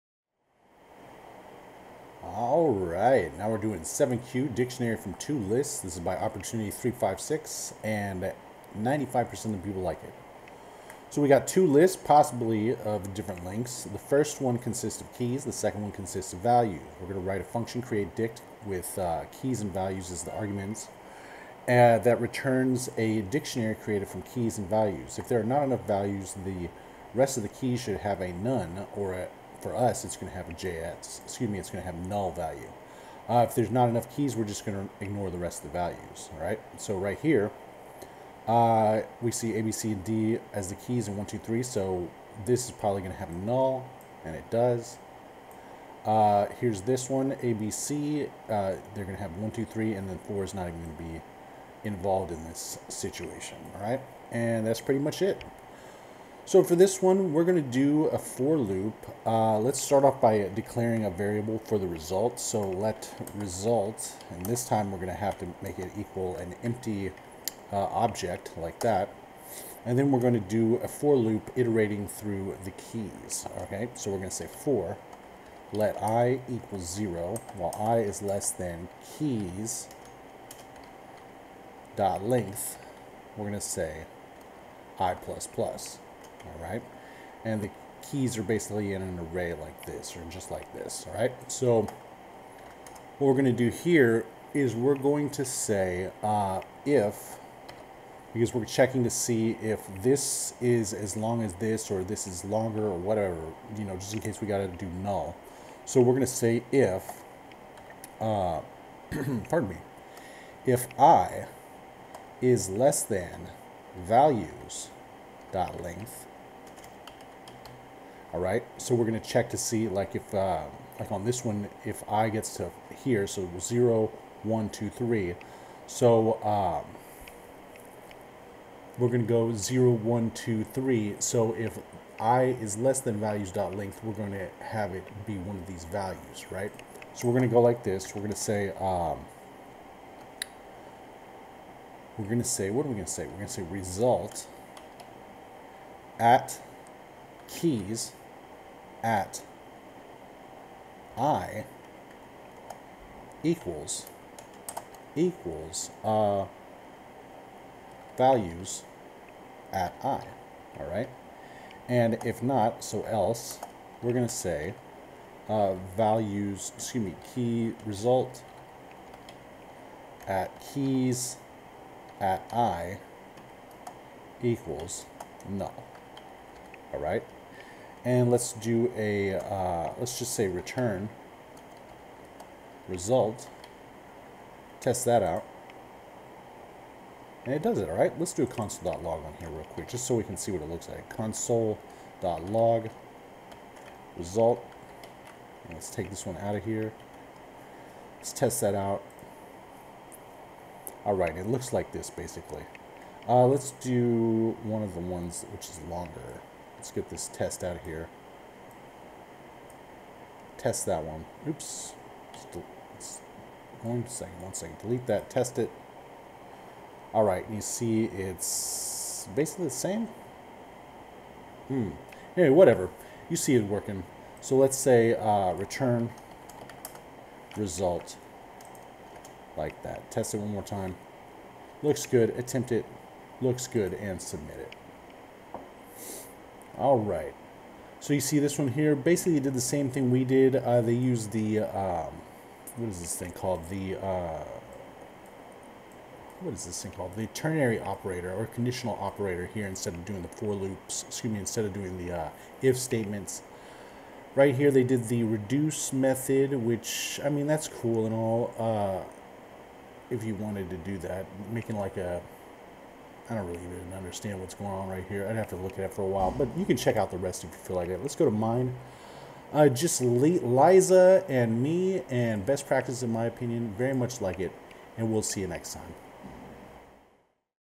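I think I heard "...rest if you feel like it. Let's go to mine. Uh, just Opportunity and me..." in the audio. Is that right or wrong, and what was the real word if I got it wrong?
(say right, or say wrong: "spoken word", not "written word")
wrong: "Liza", not "Opportunity".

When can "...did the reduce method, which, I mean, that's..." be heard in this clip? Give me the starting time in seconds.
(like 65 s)
254 s.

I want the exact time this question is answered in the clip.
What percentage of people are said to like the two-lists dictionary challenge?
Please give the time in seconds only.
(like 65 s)
8 s.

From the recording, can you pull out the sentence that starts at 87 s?
And the keys are basically in an array like this or just like this, all right?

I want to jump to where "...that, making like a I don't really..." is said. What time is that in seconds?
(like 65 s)
260 s.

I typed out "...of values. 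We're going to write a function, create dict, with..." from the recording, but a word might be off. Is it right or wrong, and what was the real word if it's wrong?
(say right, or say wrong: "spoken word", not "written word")
right.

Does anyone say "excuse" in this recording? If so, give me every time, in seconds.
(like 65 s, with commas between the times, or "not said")
31 s, 166 s, 251 s.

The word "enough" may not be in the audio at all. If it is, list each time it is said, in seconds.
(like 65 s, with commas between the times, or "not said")
25 s, 33 s.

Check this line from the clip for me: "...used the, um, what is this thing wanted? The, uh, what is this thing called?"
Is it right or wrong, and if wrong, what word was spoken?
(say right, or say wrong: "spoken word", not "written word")
wrong: "called", not "wanted".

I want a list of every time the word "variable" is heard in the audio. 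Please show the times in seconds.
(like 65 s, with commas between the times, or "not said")
61 s.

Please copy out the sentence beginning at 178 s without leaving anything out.
and let's do a, uh, let's just say return result.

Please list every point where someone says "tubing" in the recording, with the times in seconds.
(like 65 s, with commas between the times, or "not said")
not said.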